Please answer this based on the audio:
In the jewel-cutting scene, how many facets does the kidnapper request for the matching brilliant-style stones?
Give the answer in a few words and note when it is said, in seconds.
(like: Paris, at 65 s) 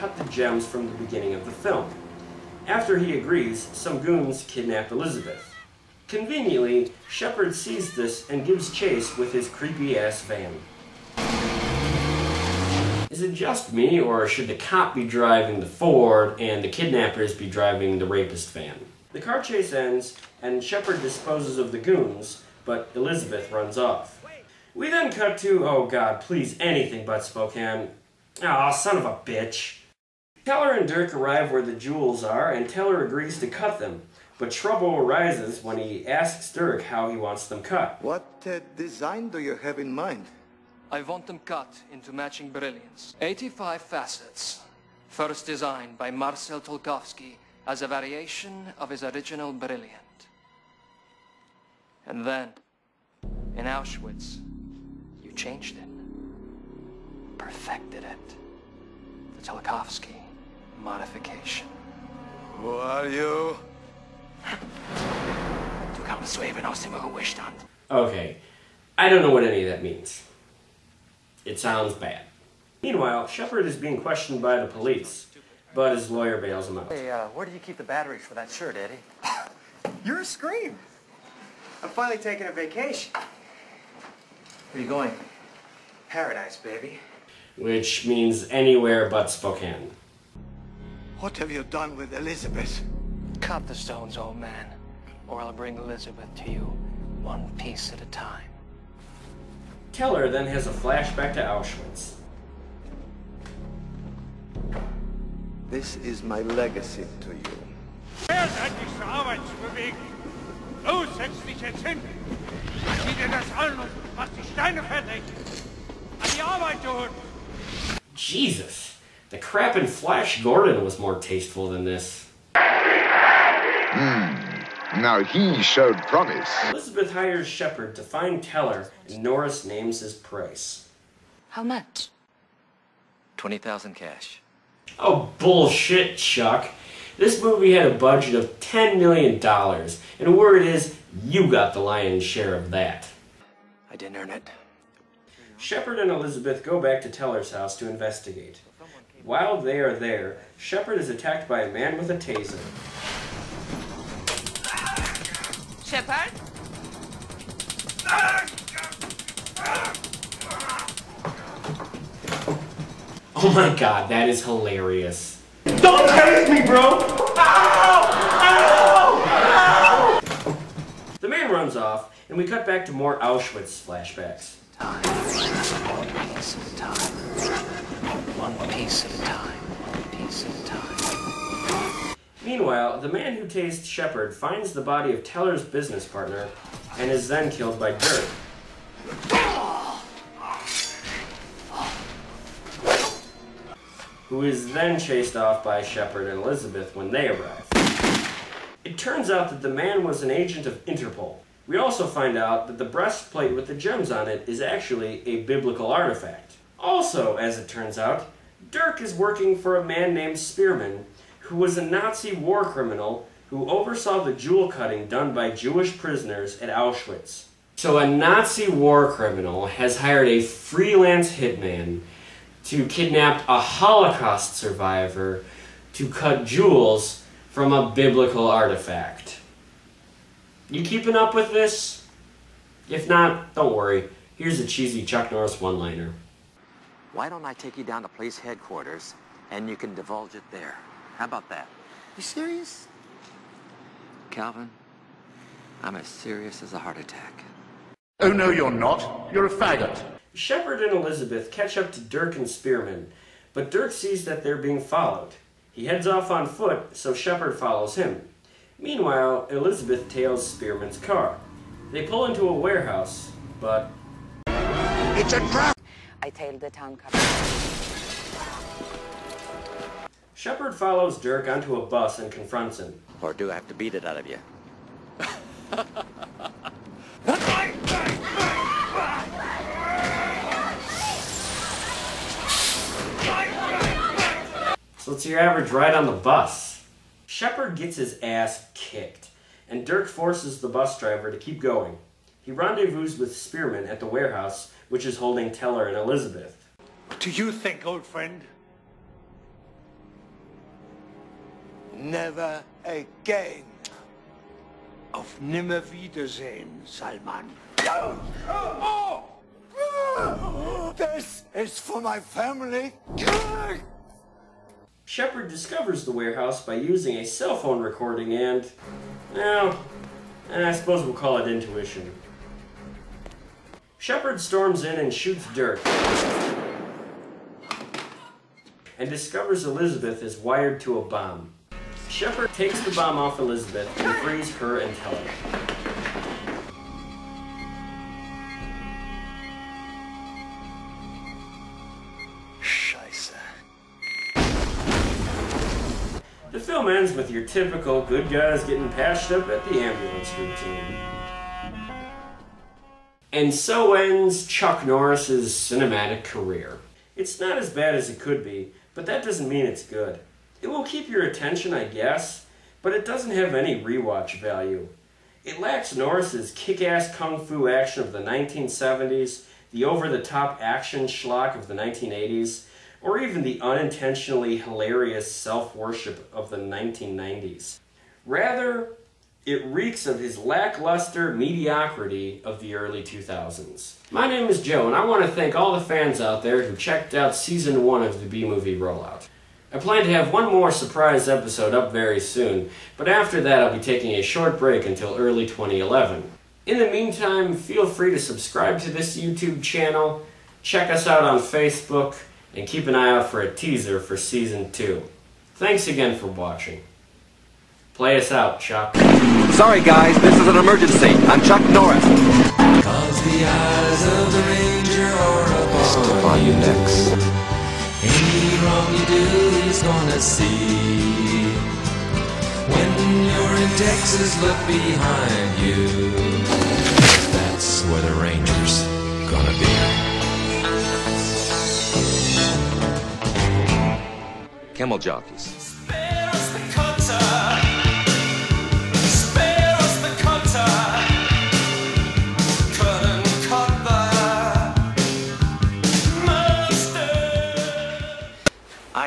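85, at 43 s.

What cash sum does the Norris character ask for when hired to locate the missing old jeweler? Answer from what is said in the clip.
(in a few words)
$20,000.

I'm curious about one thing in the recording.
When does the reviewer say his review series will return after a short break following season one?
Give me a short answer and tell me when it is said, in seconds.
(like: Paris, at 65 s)
early 2011, at 395 s.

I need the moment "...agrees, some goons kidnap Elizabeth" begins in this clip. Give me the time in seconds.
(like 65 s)
3 s.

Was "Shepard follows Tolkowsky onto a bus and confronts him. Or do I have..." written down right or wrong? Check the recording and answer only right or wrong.
wrong.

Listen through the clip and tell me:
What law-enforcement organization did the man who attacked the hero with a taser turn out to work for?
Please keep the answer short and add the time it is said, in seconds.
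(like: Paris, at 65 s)
Interpol, at 200 s.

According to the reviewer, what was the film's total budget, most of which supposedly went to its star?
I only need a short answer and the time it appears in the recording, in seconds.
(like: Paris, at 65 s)
$10 million, at 138 s.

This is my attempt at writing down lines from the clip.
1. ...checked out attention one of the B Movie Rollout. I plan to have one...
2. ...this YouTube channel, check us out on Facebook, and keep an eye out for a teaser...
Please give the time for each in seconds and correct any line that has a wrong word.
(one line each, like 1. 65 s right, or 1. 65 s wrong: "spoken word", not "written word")
1. 386 s wrong: "season", not "attention"
2. 398 s right.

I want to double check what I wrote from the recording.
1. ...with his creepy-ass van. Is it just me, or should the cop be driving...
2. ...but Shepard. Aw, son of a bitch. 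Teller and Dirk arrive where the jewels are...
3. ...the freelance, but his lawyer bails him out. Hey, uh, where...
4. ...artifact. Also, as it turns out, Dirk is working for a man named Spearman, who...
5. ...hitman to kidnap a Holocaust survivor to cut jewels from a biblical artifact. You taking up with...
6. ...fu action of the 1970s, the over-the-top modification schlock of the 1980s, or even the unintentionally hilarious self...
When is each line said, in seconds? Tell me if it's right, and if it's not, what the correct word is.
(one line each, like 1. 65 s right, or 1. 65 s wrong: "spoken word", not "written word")
1. 9 s right
2. 27 s wrong: "Spokane", not "Shepard"
3. 74 s wrong: "police", not "freelance"
4. 205 s right
5. 221 s wrong: "keeping", not "taking"
6. 367 s wrong: "action", not "modification".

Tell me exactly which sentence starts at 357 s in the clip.
It's not as bad as it could be, but that doesn't mean it's good.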